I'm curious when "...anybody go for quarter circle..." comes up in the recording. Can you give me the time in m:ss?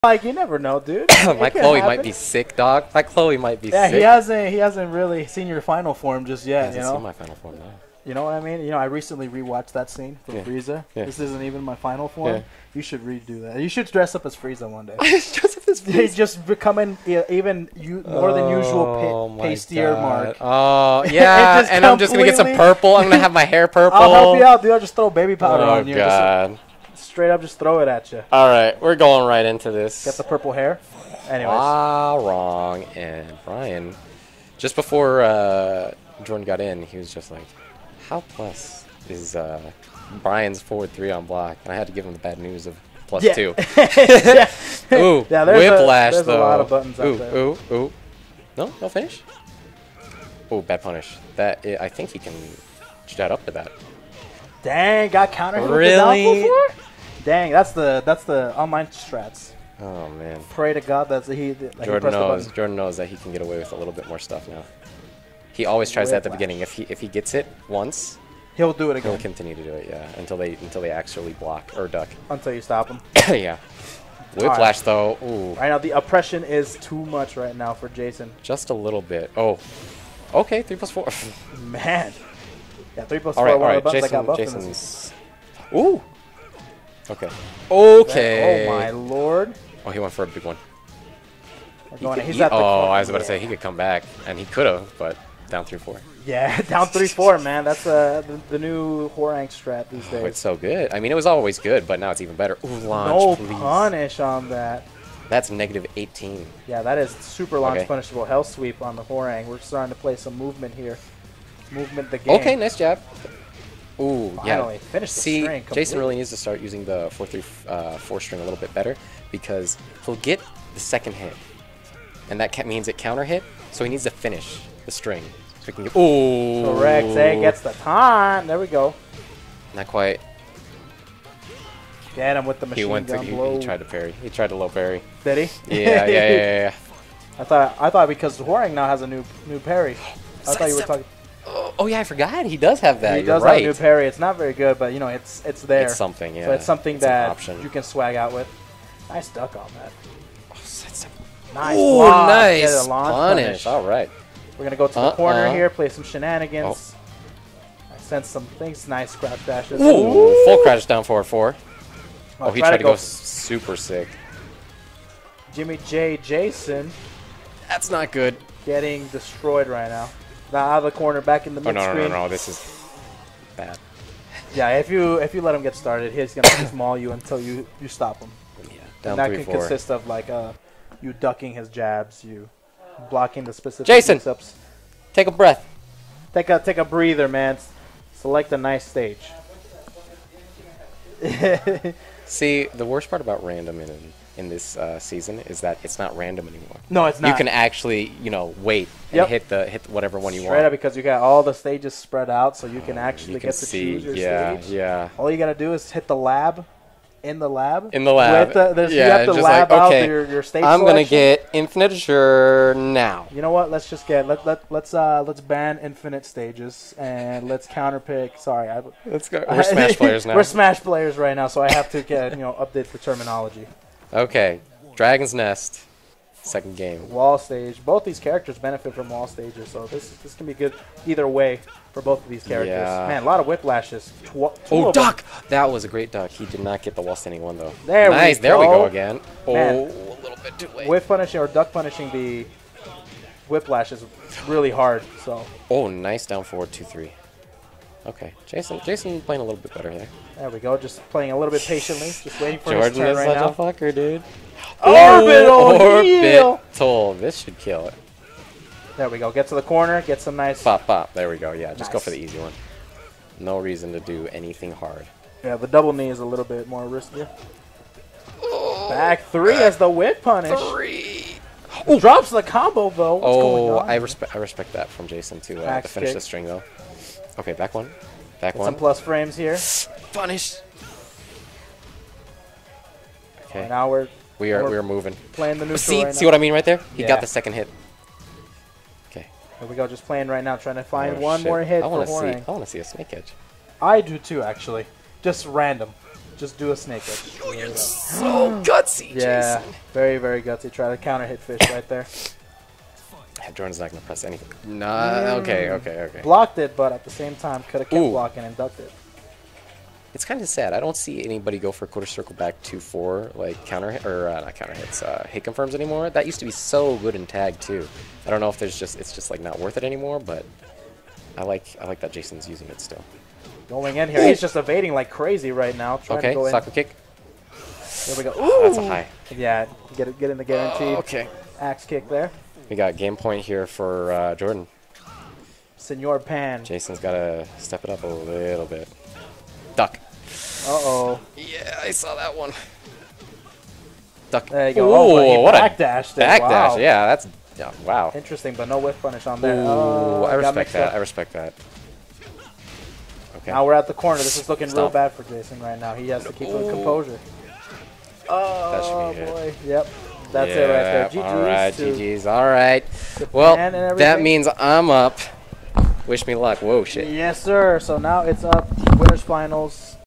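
5:11.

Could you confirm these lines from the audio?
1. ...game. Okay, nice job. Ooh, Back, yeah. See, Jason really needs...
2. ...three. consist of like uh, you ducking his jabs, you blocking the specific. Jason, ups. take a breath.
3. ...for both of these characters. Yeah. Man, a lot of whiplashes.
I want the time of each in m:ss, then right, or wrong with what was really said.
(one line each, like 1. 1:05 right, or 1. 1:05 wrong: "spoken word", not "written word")
1. 1:52 wrong: "Finally", not "Back"
2. 2:59 wrong: "four", not "three"
3. 3:51 right.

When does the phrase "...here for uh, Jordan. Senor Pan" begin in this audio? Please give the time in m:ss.
5:33.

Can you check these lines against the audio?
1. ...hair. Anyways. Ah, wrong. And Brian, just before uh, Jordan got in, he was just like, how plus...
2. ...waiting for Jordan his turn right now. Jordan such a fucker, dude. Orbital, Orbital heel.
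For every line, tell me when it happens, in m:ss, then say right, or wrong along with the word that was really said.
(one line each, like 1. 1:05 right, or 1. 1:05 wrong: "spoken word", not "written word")
1. 0:30 right
2. 4:12 right.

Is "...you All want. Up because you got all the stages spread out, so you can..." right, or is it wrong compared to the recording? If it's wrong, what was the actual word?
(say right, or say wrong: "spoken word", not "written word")
wrong: "Straight", not "All".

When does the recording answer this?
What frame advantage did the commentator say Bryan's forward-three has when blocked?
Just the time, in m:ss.
0:43.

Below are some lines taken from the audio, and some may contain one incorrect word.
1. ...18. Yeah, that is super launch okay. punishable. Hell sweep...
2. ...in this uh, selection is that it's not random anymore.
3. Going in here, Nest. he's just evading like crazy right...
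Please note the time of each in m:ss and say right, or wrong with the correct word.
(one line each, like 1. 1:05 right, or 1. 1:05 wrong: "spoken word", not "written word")
1. 1:45 right
2. 3:14 wrong: "season", not "selection"
3. 5:23 wrong: "Ooh", not "Nest".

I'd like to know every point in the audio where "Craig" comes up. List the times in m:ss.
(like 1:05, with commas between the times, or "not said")
not said.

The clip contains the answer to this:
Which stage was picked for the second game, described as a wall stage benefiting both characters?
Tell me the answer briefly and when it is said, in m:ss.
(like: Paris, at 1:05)
Dragon's Nest, at 3:44.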